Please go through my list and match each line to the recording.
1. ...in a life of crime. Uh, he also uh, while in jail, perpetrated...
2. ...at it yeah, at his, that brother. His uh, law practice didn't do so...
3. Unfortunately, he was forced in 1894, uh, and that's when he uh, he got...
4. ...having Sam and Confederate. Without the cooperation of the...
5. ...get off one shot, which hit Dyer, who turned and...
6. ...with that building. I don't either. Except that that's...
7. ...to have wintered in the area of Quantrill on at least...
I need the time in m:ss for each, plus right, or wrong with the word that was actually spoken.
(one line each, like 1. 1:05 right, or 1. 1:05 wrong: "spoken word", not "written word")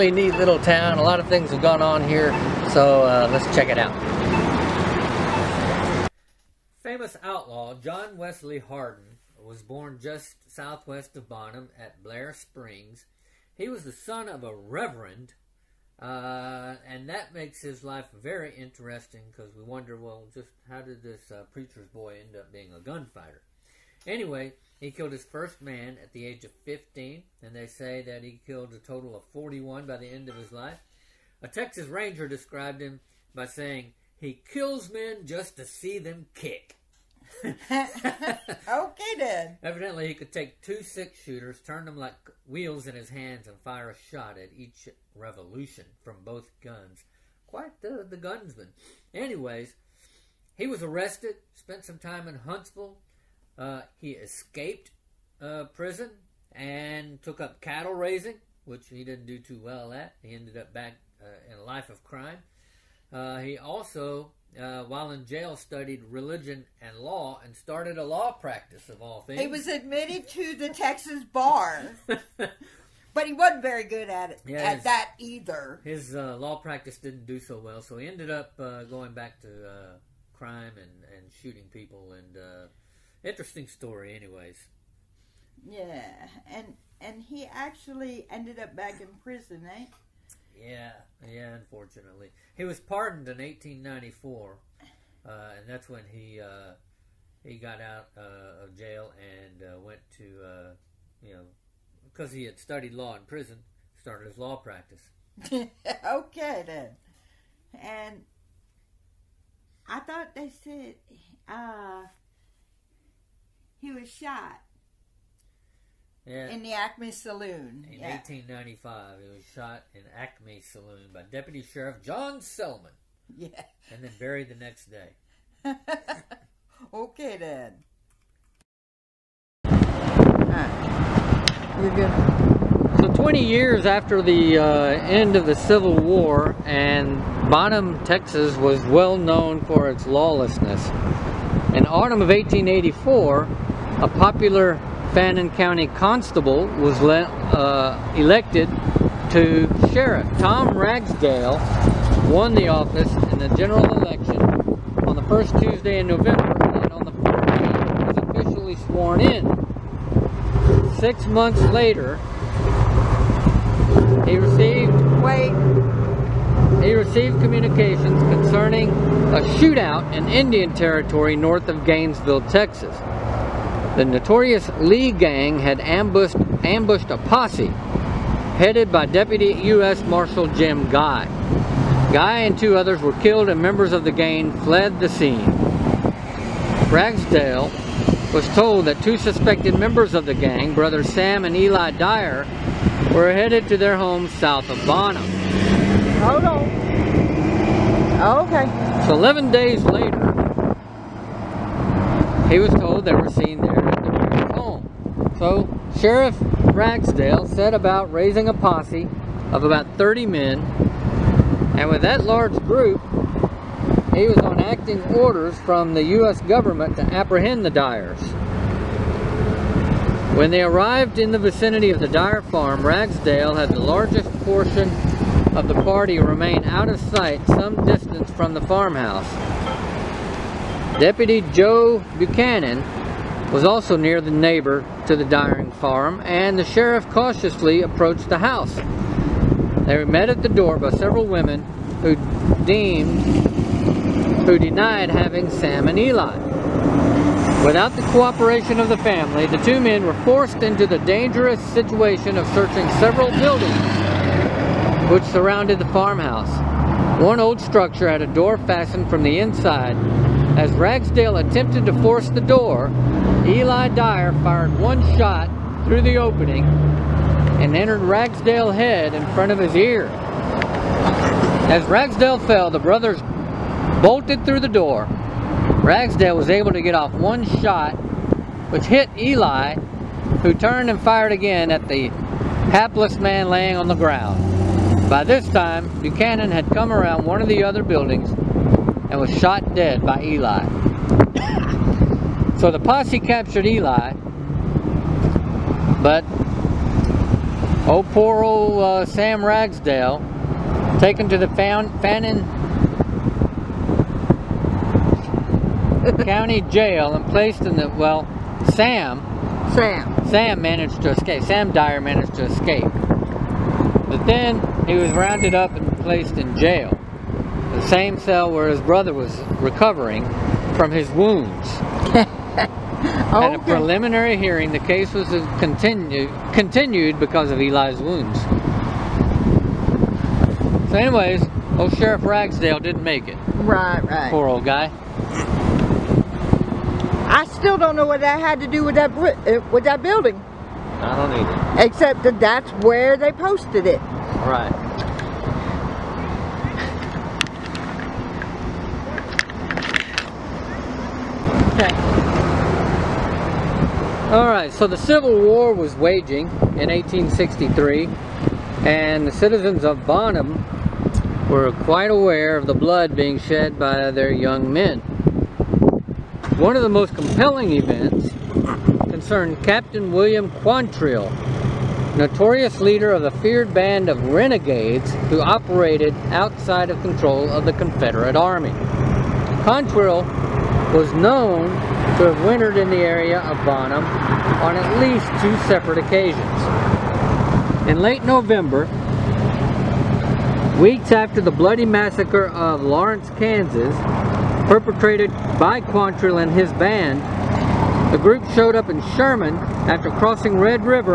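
1. 1:01 wrong: "studied", not "perpetrated"
2. 1:14 wrong: "either", not "brother"
3. 1:31 wrong: "pardoned", not "forced"
4. 4:05 wrong: "Eli", not "Confederate"
5. 4:36 wrong: "Eli", not "Dyer"
6. 5:39 right
7. 6:22 wrong: "Bonham", not "Quantrill".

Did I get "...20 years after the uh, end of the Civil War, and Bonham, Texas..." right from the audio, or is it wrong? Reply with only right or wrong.
right.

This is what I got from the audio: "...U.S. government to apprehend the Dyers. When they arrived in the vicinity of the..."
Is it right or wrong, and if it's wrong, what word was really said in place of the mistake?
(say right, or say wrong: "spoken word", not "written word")
right.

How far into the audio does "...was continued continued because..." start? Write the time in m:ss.
5:25.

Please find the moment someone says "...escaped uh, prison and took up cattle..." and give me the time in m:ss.
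0:54.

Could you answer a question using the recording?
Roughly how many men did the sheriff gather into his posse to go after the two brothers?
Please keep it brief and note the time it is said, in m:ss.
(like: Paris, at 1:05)
30, at 3:29.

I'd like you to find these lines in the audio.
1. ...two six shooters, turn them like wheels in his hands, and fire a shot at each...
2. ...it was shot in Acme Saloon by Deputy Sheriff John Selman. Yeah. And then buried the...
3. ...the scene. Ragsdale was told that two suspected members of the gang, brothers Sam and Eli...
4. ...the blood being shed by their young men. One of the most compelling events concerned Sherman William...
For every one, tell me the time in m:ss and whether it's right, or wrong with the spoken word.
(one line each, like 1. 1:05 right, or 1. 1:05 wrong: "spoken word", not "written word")
1. 0:40 right
2. 1:59 right
3. 3:05 right
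4. 6:02 wrong: "Captain", not "Sherman".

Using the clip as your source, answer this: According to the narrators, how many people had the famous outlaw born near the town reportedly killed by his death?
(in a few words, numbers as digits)
41.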